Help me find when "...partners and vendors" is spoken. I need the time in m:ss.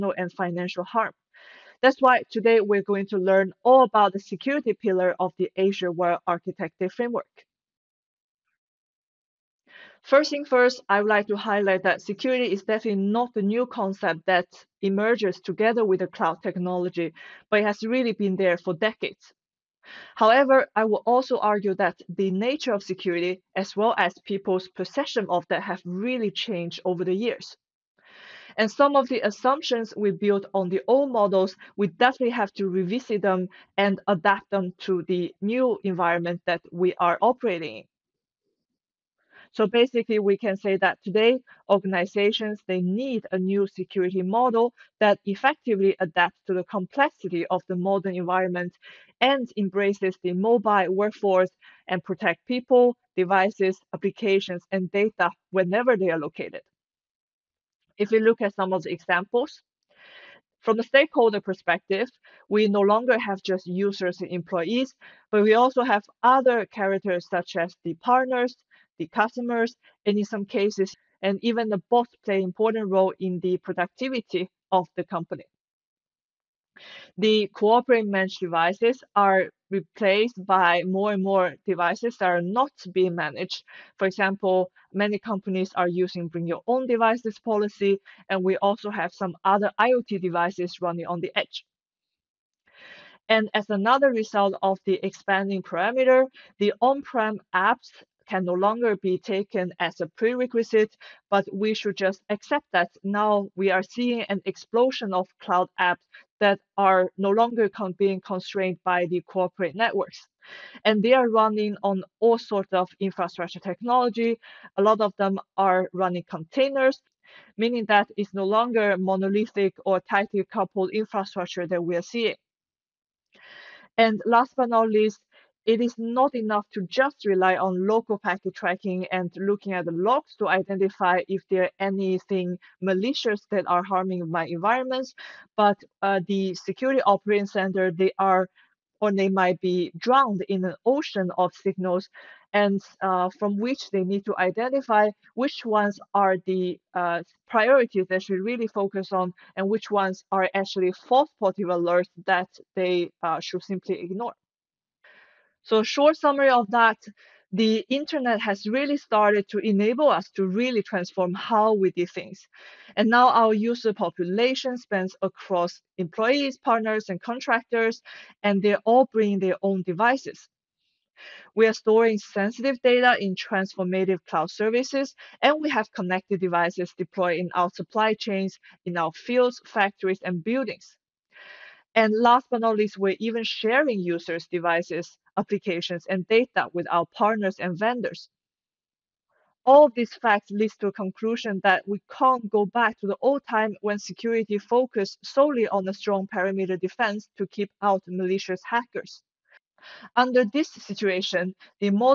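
3:07.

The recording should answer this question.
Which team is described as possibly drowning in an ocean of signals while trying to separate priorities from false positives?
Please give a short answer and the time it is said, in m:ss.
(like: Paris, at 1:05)
Security operating center, at 2:16.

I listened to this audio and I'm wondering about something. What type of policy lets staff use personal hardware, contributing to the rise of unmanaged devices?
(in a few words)
Bring your own devices.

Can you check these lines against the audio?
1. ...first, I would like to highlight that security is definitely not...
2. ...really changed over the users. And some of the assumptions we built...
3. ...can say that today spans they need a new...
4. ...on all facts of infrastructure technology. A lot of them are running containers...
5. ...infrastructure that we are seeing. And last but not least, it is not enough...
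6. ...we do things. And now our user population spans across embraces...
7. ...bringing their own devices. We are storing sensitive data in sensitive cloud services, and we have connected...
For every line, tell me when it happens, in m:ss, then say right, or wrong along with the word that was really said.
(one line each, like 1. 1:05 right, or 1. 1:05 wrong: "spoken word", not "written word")
1. 0:10 right
2. 0:25 wrong: "years", not "users"
3. 0:40 wrong: "organizations", not "spans"
4. 1:51 wrong: "sorts", not "facts"
5. 2:00 right
6. 2:41 wrong: "employees", not "embraces"
7. 2:49 wrong: "transformative", not "sensitive".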